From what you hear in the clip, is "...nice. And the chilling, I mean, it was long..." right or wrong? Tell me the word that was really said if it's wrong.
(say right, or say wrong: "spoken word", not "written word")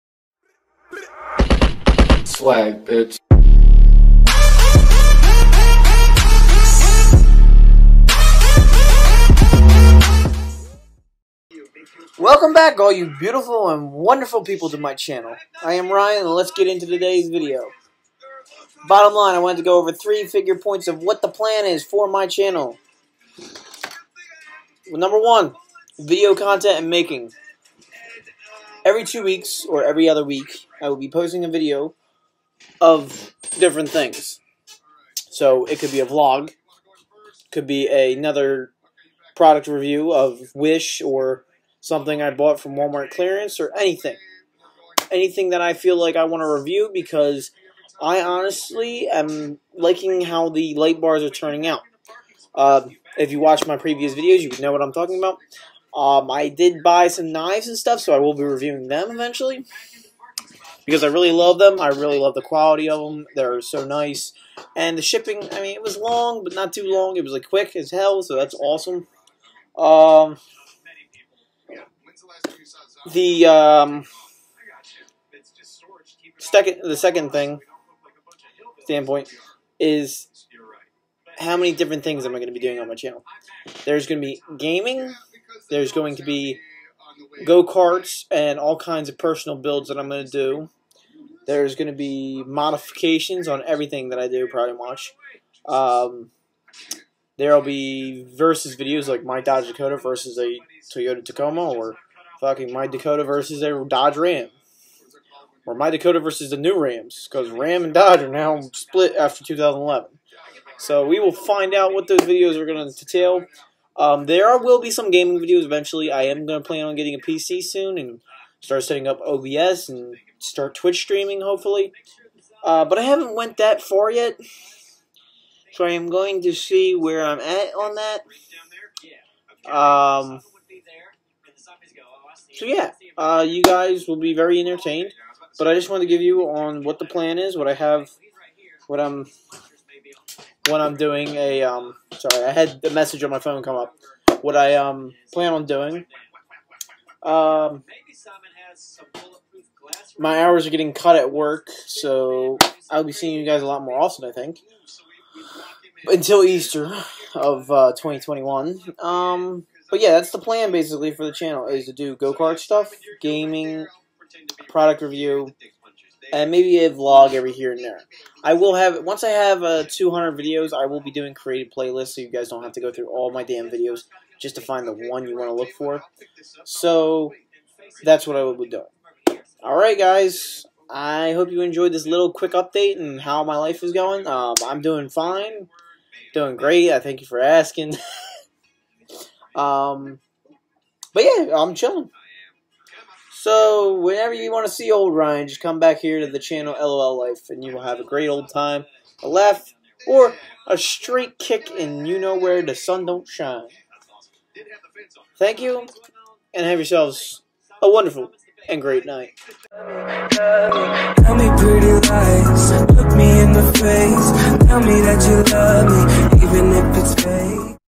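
wrong: "shipping", not "chilling".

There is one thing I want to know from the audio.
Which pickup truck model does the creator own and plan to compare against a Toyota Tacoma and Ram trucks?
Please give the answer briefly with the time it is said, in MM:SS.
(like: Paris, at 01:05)
Dodge Dakota, at 01:39.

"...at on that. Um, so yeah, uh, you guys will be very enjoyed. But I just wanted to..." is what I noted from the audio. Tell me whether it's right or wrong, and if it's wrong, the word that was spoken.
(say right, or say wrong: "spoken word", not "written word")
wrong: "entertained", not "enjoyed".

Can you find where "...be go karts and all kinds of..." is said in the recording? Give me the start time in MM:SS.
01:26.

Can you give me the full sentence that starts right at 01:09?
Um, the um, second, the second thing standpoint is how many different things am I going to be doing on my channel?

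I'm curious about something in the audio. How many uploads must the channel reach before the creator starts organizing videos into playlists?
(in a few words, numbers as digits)
200.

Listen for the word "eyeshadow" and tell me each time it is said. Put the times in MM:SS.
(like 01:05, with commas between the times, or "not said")
not said.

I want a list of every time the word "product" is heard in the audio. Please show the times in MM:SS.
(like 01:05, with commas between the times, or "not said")
00:39, 02:44.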